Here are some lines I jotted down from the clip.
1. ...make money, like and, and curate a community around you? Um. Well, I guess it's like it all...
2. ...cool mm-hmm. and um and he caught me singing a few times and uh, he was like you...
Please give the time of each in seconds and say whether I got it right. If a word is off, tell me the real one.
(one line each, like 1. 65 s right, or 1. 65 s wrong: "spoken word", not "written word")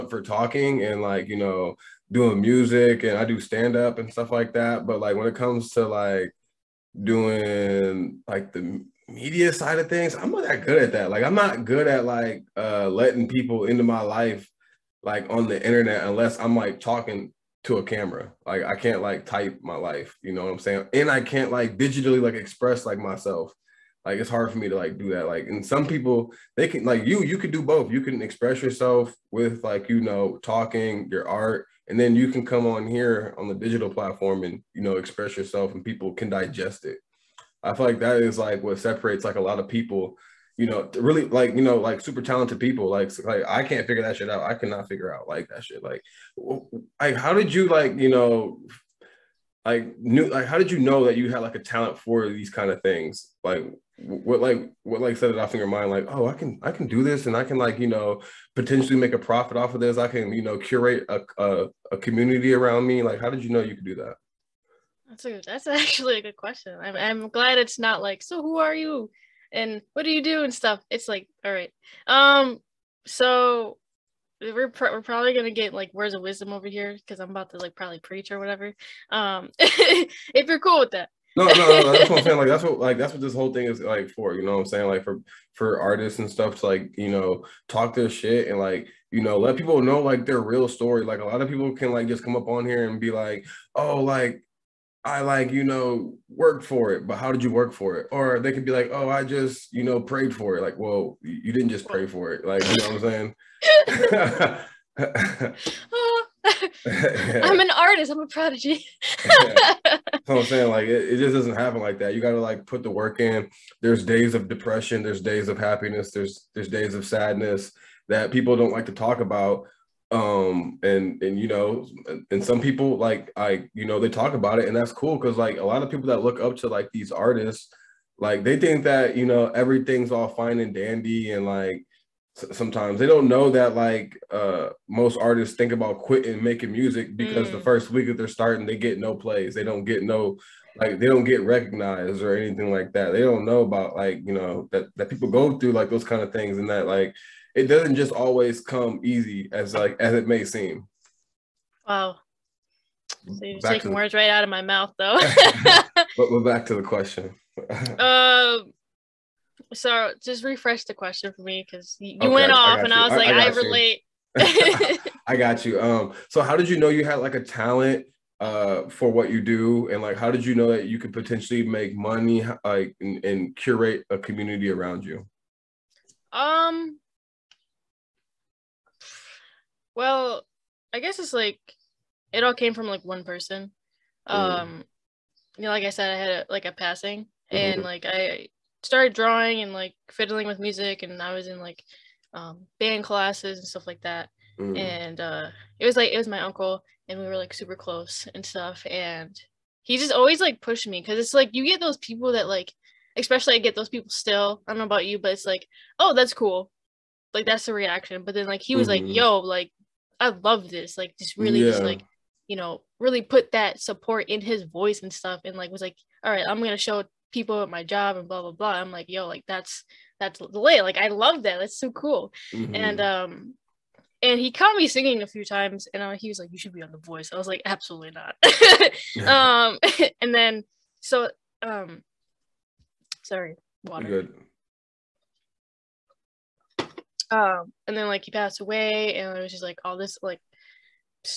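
1. 171 s right
2. 221 s right.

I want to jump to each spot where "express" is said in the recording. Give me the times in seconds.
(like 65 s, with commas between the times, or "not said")
22 s, 28 s, 34 s.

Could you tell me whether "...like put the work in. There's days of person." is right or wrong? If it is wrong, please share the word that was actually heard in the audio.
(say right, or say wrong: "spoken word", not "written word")
wrong: "depression", not "person".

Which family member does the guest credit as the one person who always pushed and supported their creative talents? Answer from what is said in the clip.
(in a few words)
uncle.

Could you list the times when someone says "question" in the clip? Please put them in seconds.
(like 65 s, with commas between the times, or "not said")
66 s, 156 s, 160 s.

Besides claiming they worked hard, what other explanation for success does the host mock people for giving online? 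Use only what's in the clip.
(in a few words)
prayed for it.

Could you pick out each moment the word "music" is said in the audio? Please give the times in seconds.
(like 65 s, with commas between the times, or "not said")
2 s, 136 s, 190 s.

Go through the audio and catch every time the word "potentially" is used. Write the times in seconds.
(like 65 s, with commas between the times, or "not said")
58 s, 171 s.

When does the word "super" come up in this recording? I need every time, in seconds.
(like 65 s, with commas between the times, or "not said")
42 s, 197 s.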